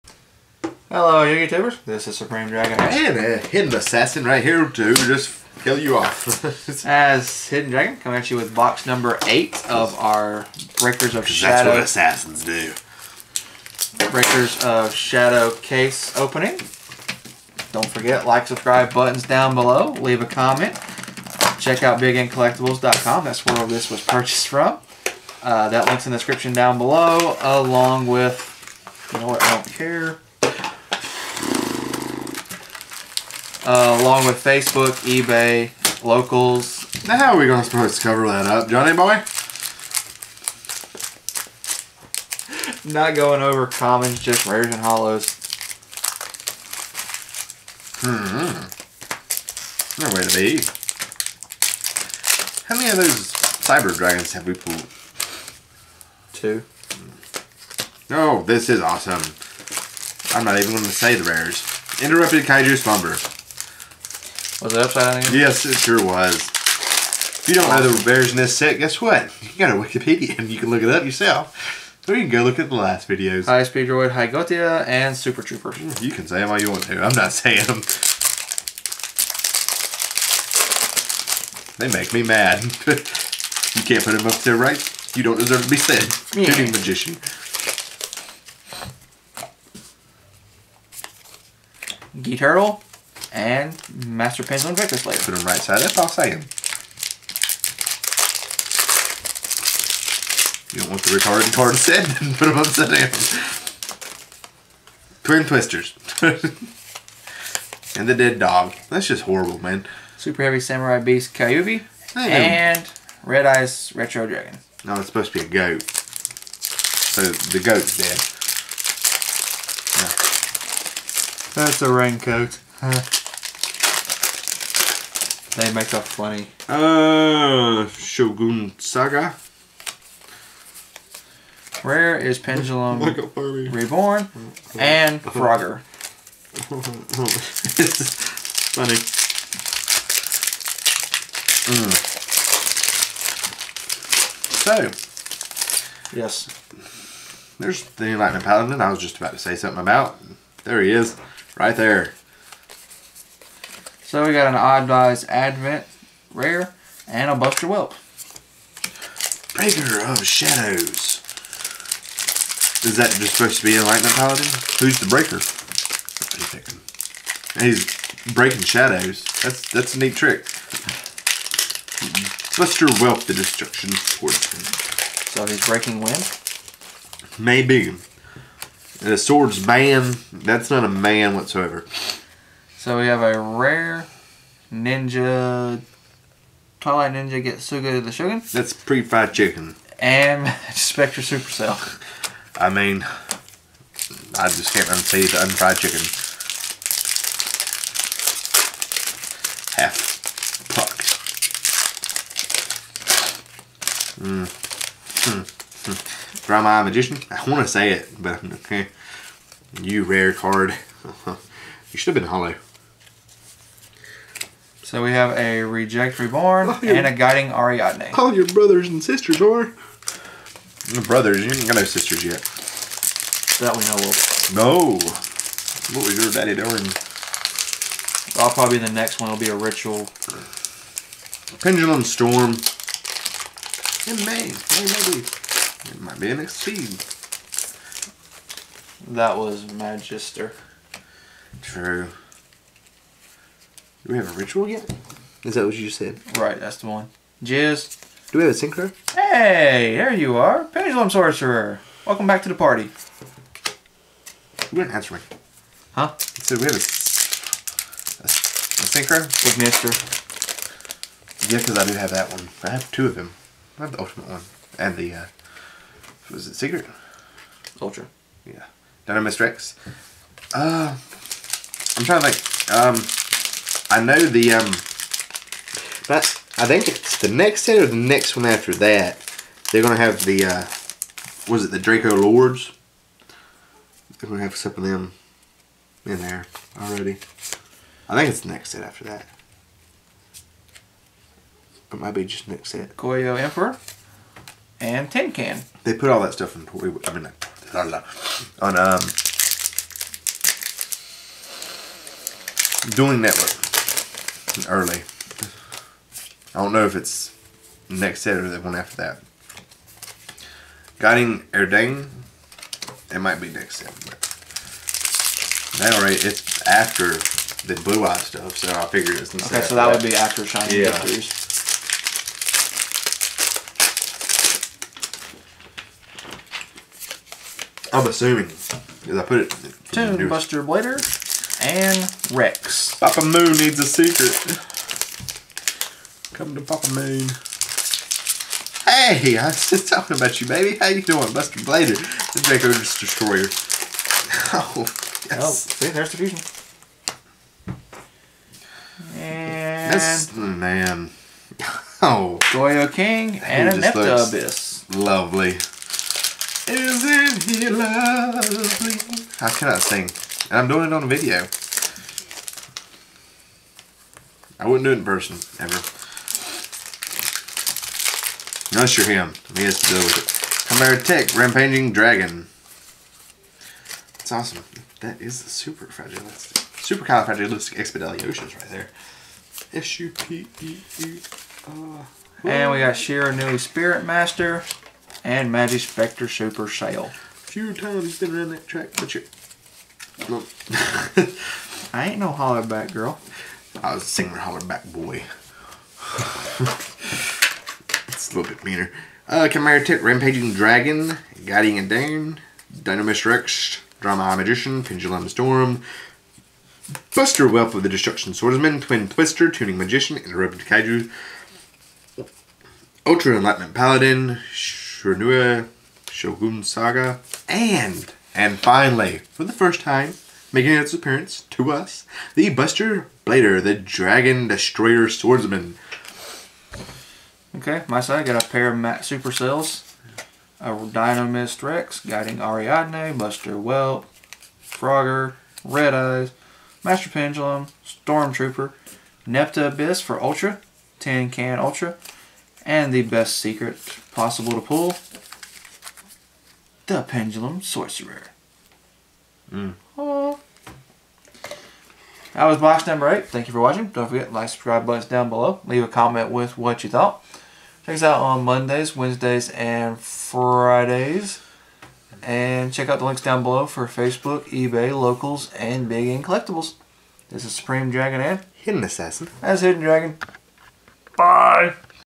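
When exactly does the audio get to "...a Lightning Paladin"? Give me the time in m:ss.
2:43.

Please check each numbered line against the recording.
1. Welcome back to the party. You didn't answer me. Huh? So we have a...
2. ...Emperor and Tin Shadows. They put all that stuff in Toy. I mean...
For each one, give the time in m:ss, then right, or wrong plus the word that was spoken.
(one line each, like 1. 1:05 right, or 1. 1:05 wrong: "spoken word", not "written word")
1. 4:12 right
2. 4:53 wrong: "Can", not "Shadows".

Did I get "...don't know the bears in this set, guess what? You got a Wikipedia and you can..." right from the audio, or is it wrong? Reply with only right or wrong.
right.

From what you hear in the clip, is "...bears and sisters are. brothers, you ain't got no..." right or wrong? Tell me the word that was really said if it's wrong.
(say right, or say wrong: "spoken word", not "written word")
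wrong: "brothers", not "bears".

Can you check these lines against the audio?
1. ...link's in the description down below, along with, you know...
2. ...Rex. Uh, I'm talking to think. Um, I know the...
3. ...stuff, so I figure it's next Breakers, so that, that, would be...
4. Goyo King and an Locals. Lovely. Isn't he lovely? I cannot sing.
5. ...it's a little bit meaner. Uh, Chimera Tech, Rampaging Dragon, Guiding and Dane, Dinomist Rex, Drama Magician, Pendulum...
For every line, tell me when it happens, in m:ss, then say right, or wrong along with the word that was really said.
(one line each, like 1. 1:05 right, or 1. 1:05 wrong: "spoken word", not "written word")
1. 0:25 right
2. 4:29 wrong: "trying", not "talking"
3. 5:18 wrong: "Okay", not "Breakers"
4. 5:52 wrong: "Abyss", not "Locals"
5. 6:38 right.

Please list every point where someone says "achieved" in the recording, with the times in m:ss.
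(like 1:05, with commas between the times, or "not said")
not said.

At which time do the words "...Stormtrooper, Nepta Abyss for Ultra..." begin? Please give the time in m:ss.
7:17.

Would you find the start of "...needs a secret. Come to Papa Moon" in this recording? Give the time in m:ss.
5:33.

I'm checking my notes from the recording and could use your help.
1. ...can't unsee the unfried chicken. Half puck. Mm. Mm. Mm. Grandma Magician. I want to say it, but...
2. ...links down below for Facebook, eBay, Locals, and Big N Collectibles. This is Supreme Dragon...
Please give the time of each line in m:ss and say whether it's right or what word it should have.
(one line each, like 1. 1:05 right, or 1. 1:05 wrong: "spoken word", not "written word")
1. 3:14 right
2. 7:43 right.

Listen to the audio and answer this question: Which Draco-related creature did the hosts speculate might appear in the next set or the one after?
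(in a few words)
Draco Lords.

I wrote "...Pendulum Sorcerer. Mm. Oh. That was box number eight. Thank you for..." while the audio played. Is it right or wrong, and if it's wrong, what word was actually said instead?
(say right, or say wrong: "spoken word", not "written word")
right.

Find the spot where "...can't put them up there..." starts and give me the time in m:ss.
1:23.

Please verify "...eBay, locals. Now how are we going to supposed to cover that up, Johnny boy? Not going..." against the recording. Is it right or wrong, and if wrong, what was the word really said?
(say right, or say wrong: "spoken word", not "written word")
right.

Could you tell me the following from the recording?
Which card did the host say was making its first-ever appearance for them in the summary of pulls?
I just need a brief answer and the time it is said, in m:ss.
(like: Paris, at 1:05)
Buster Blader, the Dragon Destroyer Swordsman, at 7:02.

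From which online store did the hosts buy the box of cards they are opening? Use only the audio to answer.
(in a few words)
BigNCollectibles.com.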